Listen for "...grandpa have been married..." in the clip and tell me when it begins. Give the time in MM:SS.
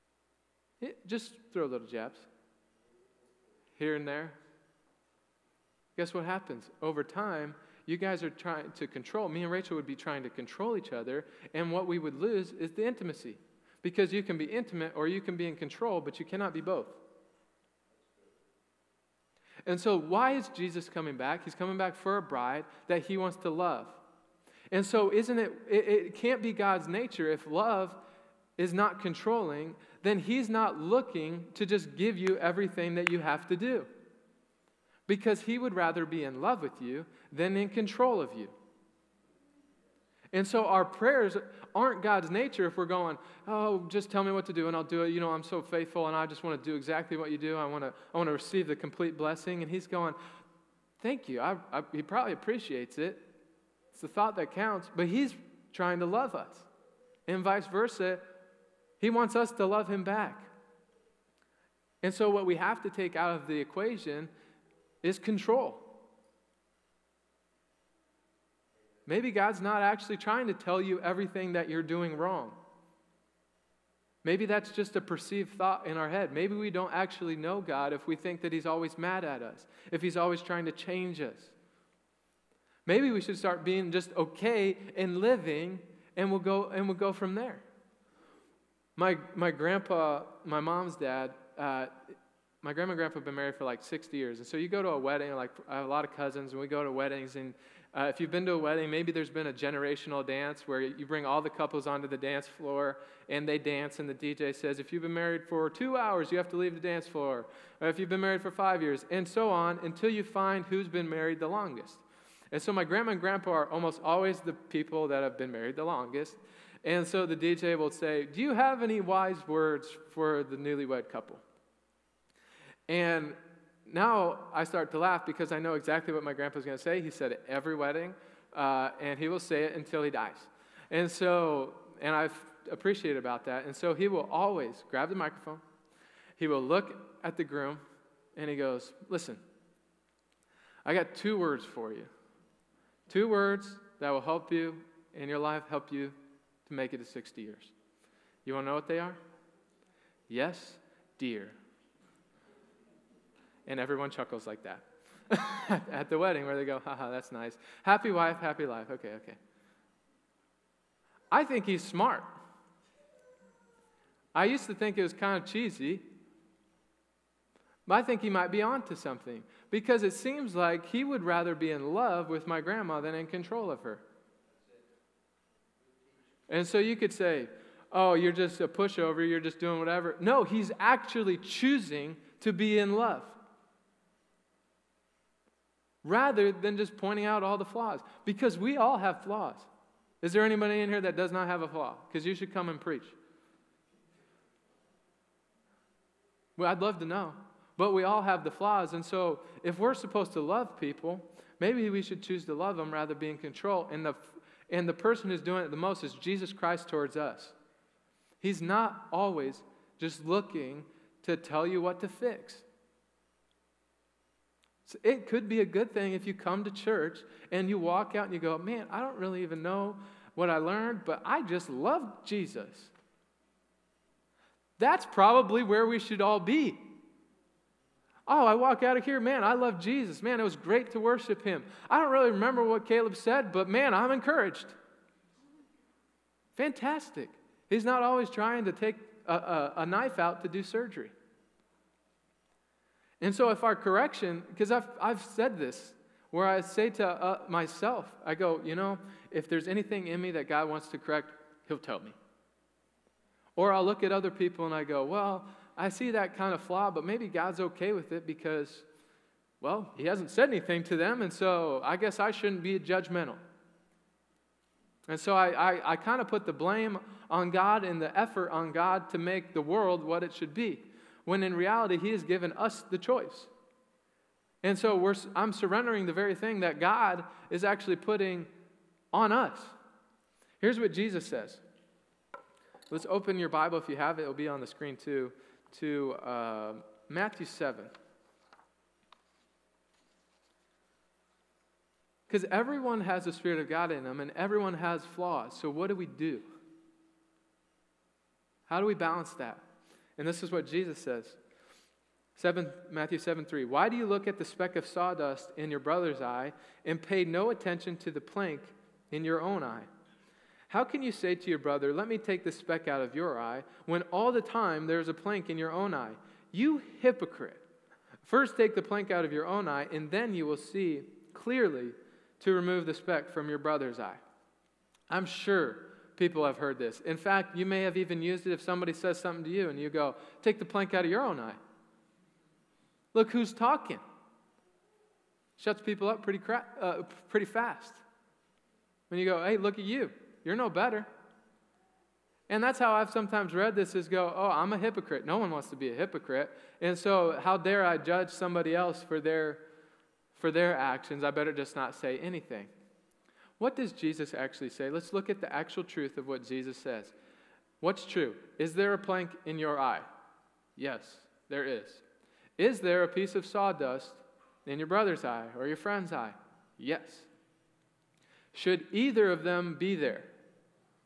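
01:32.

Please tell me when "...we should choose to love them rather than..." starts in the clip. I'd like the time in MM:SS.
03:21.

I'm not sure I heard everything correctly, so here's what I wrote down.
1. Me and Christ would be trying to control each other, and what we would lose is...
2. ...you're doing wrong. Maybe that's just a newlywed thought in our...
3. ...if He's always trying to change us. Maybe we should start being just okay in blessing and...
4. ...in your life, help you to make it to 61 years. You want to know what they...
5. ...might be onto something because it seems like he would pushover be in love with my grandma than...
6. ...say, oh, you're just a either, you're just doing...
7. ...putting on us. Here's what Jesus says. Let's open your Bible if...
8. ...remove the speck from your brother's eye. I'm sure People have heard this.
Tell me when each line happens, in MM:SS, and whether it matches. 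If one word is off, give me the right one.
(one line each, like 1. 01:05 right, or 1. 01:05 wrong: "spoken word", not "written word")
1. 00:09 wrong: "Rachel", not "Christ"
2. 01:11 wrong: "perceived", not "newlywed"
3. 01:19 wrong: "living", not "blessing"
4. 02:25 wrong: "60", not "61"
5. 02:48 wrong: "rather", not "pushover"
6. 02:57 wrong: "pushover", not "either"
7. 04:37 right
8. 05:22 right.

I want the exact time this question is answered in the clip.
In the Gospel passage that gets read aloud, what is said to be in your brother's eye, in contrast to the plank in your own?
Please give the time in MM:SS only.
05:04.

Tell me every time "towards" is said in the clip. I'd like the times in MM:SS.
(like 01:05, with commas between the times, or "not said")
03:26.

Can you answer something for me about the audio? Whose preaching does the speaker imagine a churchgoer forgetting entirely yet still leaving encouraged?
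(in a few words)
Caleb.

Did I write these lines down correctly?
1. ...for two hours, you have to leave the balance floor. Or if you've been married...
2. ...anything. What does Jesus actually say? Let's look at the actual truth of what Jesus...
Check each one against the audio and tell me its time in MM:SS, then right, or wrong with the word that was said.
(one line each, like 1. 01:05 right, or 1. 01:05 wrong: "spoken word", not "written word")
1. 01:45 wrong: "dance", not "balance"
2. 05:52 right.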